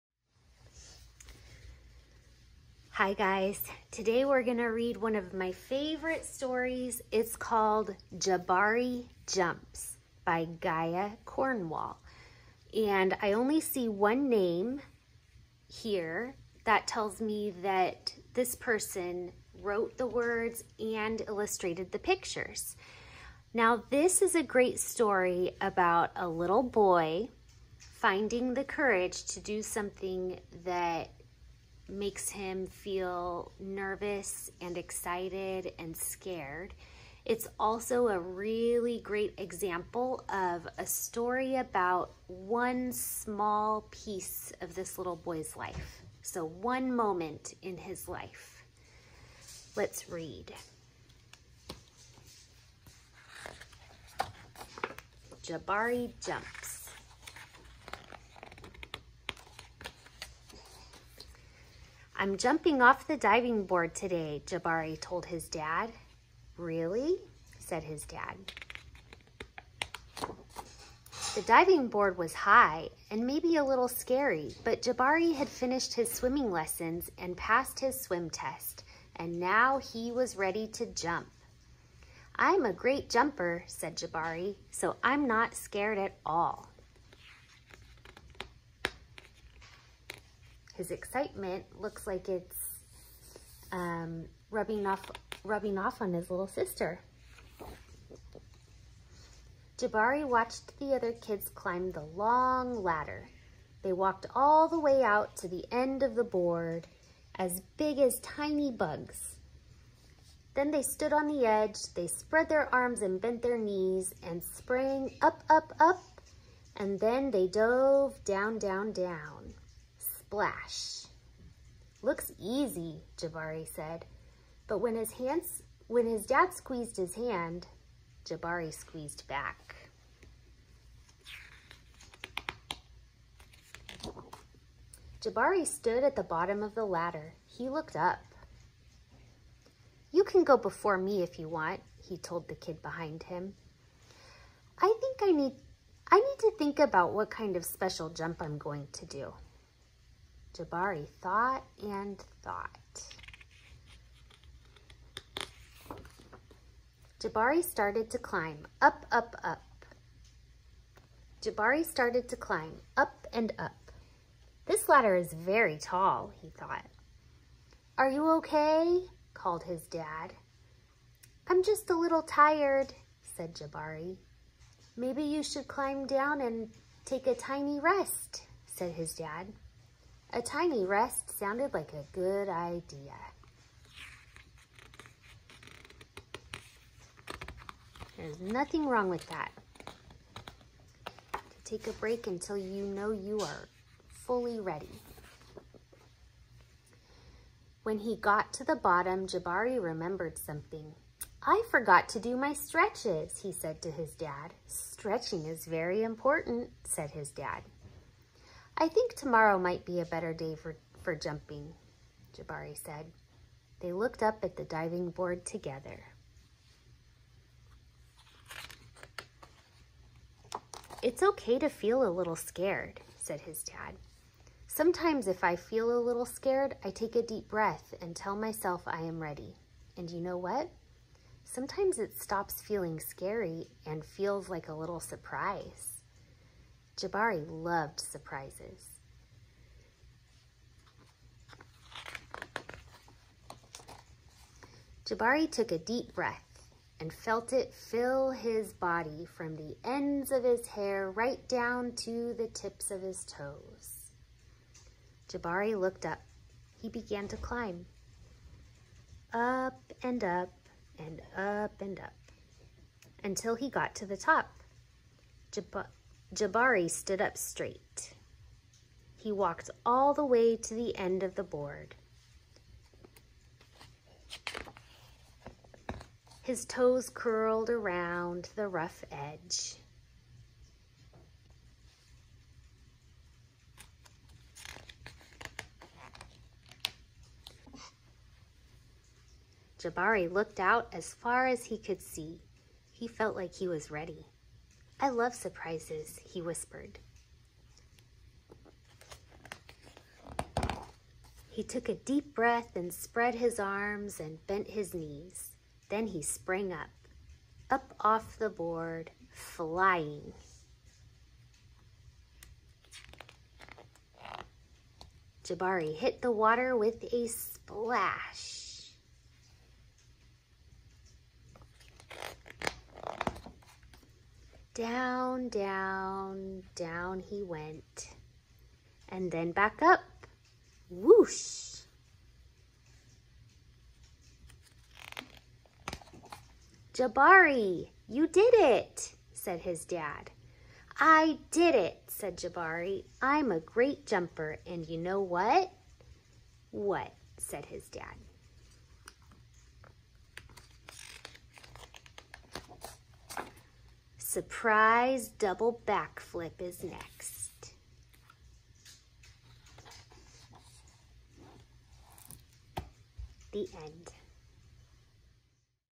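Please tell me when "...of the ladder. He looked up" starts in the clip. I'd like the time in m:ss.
2:16.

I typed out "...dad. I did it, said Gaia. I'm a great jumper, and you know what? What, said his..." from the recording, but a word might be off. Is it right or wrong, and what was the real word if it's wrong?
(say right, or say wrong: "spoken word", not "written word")
wrong: "Jabari", not "Gaia".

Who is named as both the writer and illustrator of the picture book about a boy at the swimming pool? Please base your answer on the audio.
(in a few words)
Gaia Cornwall.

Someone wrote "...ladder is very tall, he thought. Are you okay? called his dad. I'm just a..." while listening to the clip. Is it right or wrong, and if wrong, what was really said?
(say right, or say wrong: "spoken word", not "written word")
right.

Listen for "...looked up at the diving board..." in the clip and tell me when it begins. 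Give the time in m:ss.
3:33.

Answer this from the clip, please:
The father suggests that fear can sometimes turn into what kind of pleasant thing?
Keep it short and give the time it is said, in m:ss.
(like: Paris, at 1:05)
a little surprise, at 3:54.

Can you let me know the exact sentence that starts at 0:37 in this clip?
It's also a really great example of a story about one small piece of this little boy's life.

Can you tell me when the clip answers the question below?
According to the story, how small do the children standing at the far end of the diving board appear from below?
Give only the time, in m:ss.
1:48.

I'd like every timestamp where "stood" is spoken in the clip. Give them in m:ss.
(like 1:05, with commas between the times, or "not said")
1:50, 2:15, 4:26.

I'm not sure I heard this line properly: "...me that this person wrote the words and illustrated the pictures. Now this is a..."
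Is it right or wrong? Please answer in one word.
right.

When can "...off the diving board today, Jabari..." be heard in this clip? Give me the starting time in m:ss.
1:02.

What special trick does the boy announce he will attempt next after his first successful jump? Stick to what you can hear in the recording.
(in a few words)
double backflip.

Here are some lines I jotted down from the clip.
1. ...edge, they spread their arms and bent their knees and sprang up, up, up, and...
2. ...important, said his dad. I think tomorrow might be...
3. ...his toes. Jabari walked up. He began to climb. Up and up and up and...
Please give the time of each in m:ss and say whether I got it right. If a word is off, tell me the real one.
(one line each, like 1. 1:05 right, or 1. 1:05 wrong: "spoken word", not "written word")
1. 1:51 right
2. 3:26 right
3. 4:13 wrong: "looked", not "walked".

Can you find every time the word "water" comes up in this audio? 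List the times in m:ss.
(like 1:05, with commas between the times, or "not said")
5:16.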